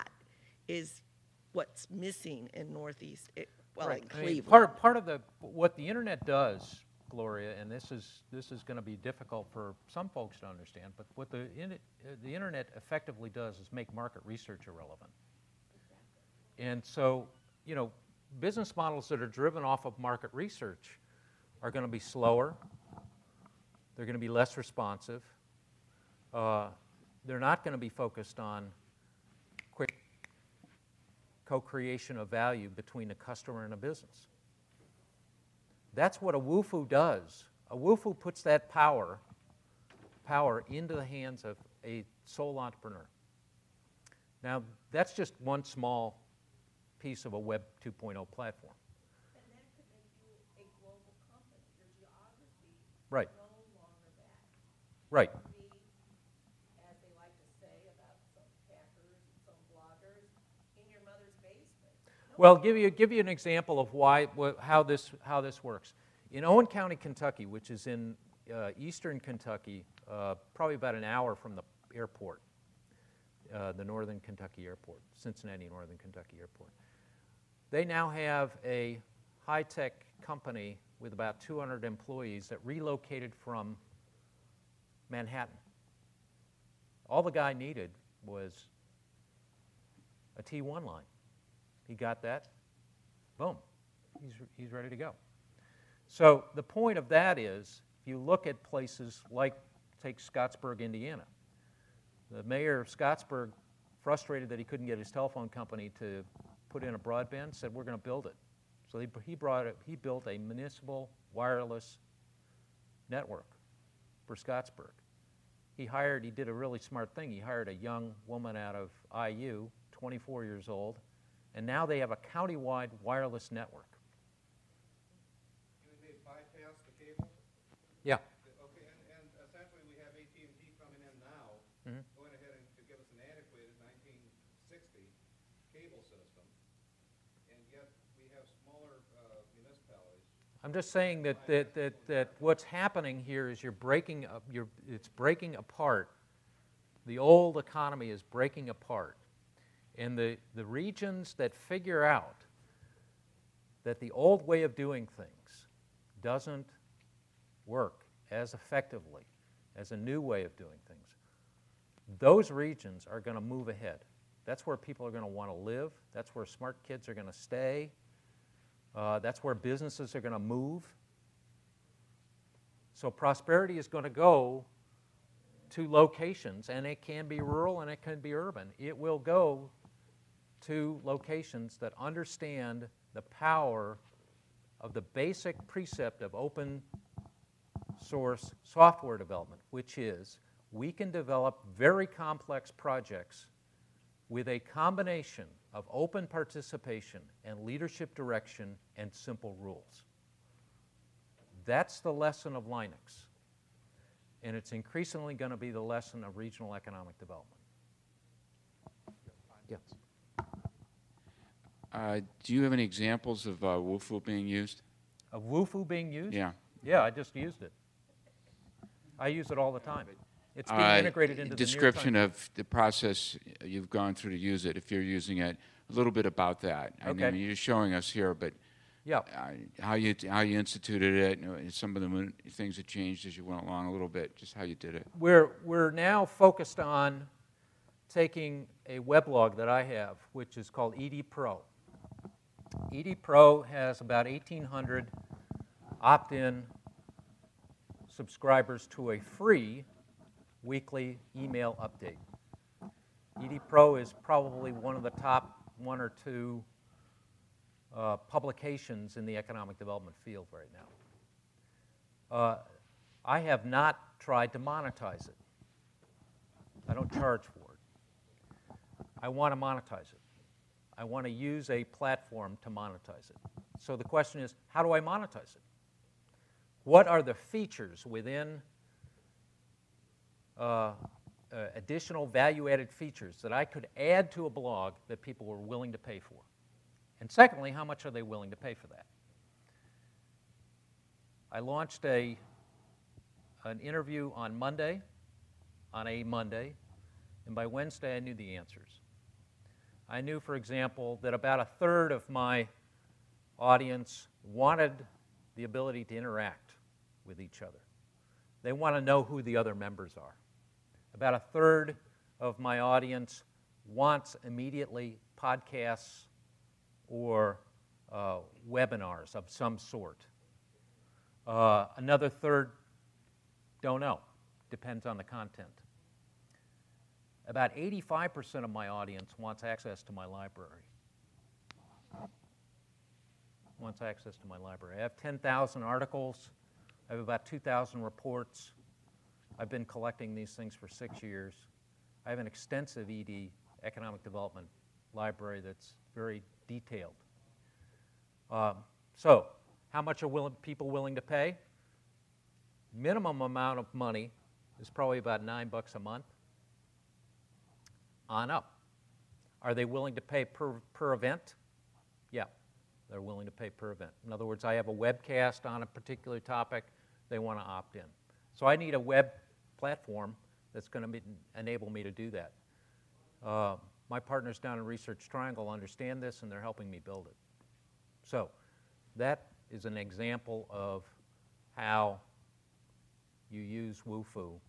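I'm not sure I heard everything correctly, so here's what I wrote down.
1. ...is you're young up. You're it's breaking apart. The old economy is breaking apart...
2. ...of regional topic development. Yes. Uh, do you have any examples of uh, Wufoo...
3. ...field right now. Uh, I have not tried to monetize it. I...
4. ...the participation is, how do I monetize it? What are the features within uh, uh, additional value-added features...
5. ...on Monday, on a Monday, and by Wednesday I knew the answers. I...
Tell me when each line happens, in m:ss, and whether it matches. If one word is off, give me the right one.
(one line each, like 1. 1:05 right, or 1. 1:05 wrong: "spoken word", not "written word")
1. 2:23 wrong: "breaking", not "young"
2. 3:26 wrong: "economic", not "topic"
3. 4:20 right
4. 4:33 wrong: "question", not "participation"
5. 4:54 right.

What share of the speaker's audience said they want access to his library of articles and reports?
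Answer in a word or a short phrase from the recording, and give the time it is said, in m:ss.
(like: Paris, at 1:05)
85%, at 5:27.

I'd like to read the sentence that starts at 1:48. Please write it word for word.
So he, he, brought it, he built a municipal wireless network for Scottsburg.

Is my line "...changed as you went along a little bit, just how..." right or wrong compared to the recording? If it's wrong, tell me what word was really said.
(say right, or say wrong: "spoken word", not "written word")
right.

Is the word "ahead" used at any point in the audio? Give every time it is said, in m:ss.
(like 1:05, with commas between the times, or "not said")
2:12, 2:43.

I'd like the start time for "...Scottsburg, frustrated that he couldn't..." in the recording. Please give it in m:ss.
1:42.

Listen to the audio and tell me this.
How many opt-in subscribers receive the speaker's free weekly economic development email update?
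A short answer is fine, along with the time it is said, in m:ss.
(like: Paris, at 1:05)
1,800, at 4:04.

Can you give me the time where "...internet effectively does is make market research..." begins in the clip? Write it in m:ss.
0:12.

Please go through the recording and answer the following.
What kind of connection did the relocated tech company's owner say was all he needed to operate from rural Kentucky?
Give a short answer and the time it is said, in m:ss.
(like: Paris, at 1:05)
T1 line, at 1:30.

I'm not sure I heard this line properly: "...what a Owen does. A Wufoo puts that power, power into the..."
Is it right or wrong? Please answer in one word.
wrong.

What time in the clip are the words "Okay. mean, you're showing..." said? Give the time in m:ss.
3:47.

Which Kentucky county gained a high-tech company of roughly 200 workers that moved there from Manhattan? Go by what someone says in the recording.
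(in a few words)
Owen County.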